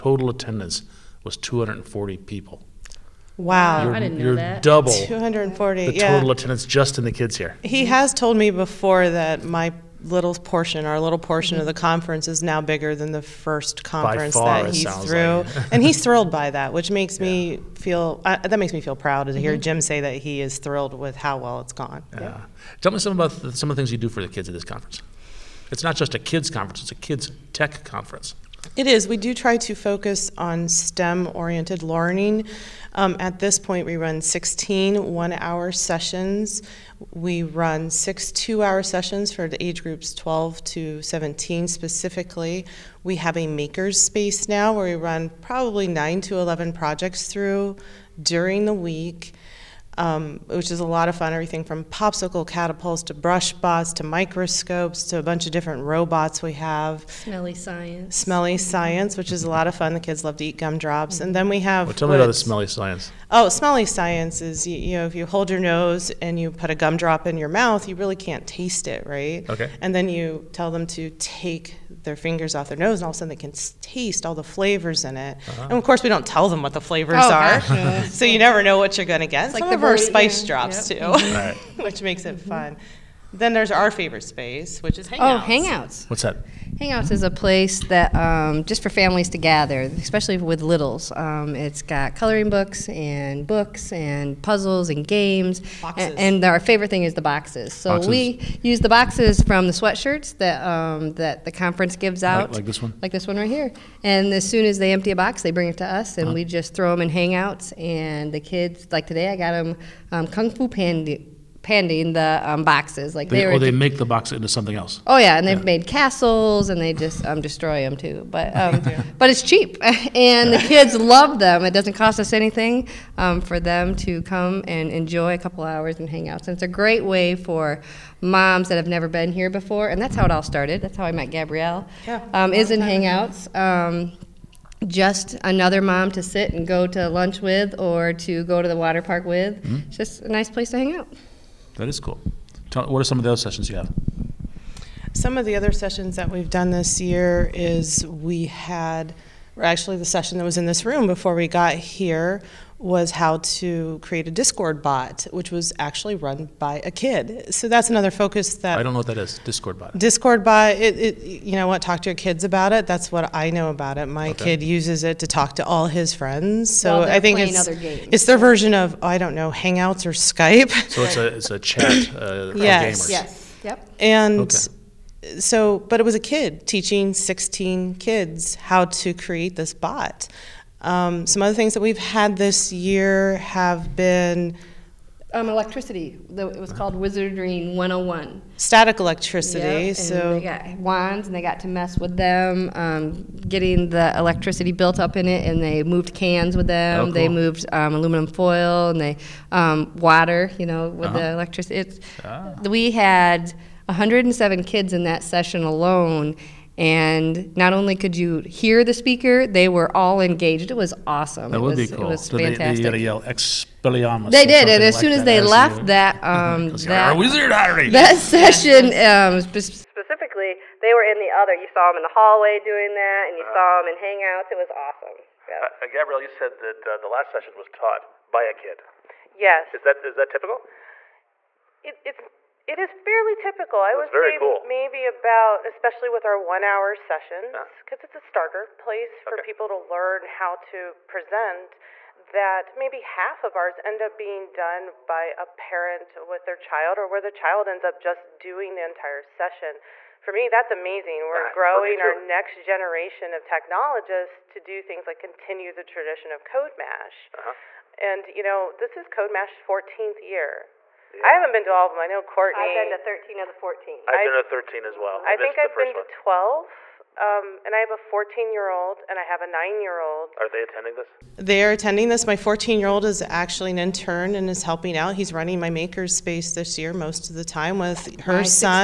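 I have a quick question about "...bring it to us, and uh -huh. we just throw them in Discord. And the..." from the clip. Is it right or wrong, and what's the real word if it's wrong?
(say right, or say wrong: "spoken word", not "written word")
wrong: "Hangouts", not "Discord".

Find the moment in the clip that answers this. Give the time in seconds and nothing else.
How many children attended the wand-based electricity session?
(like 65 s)
203 s.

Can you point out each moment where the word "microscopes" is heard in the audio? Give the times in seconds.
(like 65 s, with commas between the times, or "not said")
54 s.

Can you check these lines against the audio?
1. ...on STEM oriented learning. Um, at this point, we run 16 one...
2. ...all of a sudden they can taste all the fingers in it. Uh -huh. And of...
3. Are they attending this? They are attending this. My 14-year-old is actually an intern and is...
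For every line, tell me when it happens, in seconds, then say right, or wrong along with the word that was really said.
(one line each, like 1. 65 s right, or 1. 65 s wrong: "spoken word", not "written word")
1. 30 s right
2. 73 s wrong: "flavors", not "fingers"
3. 270 s right.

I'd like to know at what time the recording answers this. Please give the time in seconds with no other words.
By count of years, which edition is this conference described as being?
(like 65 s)
259 s.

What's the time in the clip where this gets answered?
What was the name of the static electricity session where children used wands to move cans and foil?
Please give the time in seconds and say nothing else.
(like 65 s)
186 s.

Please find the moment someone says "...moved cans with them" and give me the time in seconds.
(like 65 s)
195 s.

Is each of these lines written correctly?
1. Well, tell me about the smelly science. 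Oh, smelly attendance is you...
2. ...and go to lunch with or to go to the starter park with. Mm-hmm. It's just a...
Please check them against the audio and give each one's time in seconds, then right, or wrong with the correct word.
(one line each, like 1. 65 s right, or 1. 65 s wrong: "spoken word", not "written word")
1. 61 s wrong: "science", not "attendance"
2. 136 s wrong: "water", not "starter".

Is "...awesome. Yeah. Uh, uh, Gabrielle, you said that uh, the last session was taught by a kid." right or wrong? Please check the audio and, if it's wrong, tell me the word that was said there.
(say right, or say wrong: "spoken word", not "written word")
right.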